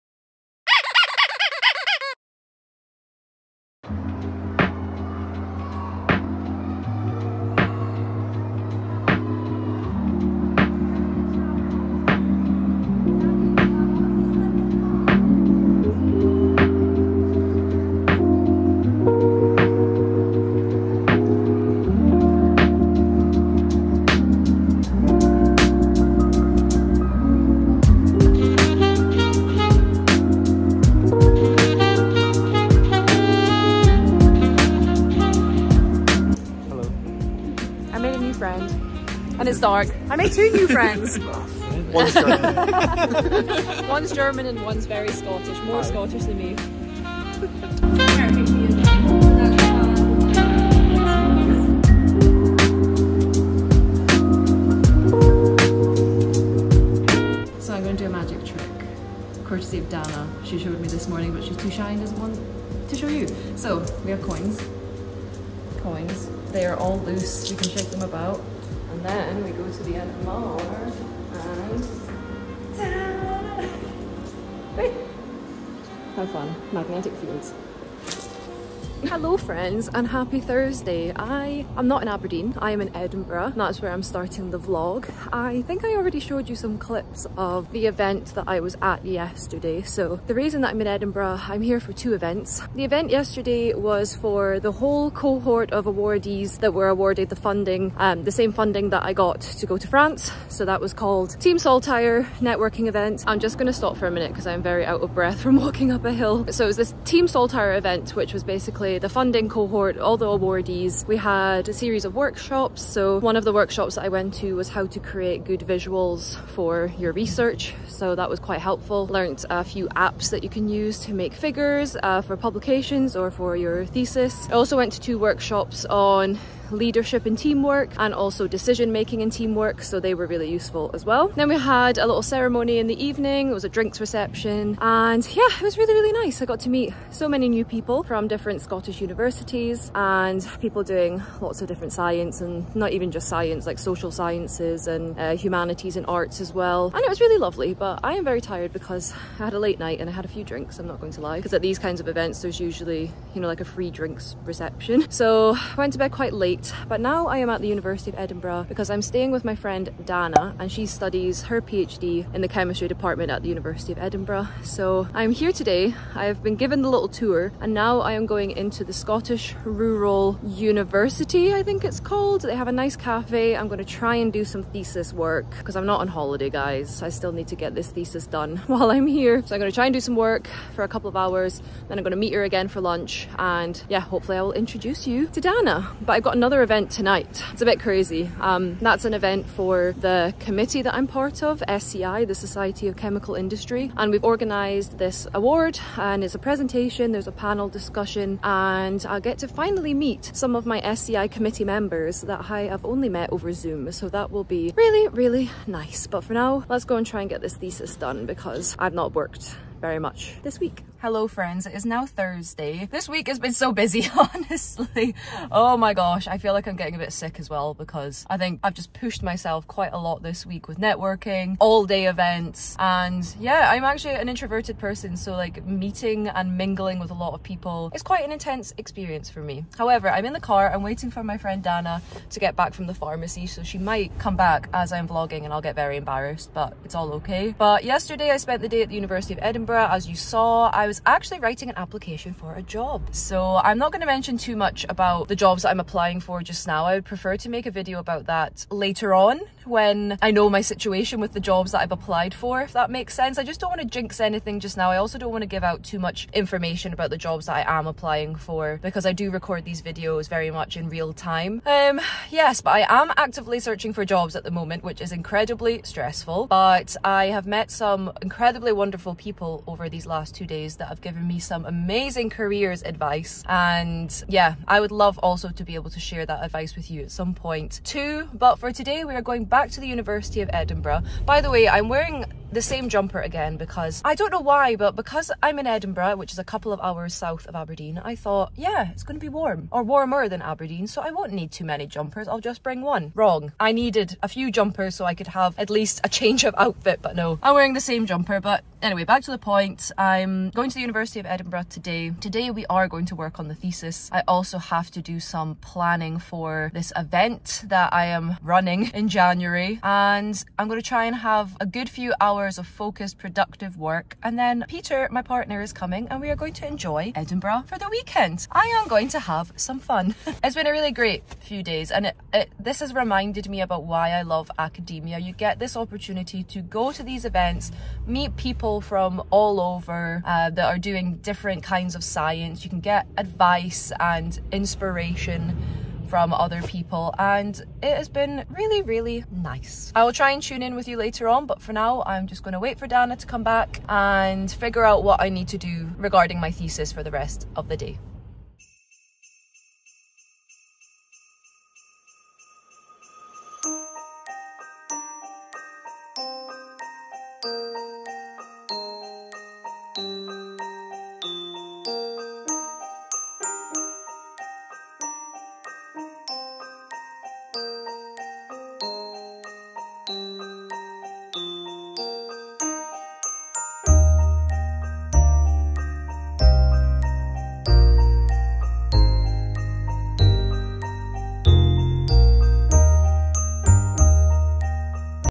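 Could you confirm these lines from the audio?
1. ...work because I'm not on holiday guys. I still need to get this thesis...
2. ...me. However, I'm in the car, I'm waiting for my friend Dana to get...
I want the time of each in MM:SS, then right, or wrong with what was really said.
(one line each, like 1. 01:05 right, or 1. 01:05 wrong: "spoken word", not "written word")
1. 02:55 right
2. 03:49 right.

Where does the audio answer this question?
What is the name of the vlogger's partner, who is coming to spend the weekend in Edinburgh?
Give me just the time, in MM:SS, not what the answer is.
05:14.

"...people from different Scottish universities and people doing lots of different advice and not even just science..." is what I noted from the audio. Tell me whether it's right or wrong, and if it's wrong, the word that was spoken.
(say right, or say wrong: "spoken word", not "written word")
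wrong: "science", not "advice".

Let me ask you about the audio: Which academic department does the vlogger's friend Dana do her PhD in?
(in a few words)
Chemistry.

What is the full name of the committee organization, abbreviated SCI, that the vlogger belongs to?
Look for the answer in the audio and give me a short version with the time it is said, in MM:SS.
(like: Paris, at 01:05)
Society of Chemical Industry, at 03:12.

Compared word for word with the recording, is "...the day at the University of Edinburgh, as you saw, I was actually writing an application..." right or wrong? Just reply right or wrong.
right.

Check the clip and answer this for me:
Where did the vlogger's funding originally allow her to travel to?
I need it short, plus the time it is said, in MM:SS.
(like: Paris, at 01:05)
France, at 01:39.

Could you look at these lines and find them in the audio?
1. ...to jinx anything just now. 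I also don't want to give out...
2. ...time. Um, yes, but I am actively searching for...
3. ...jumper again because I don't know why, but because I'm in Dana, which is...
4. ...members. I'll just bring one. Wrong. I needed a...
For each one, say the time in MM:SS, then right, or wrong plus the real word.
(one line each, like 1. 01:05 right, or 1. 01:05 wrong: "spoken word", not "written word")
1. 04:13 right
2. 04:21 right
3. 04:42 wrong: "Edinburgh", not "Dana"
4. 04:51 wrong: "jumpers", not "members".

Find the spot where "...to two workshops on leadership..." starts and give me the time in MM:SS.
02:04.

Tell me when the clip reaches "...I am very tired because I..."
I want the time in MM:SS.
02:28.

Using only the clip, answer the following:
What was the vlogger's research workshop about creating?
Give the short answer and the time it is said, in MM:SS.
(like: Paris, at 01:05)
Good visuals, at 01:55.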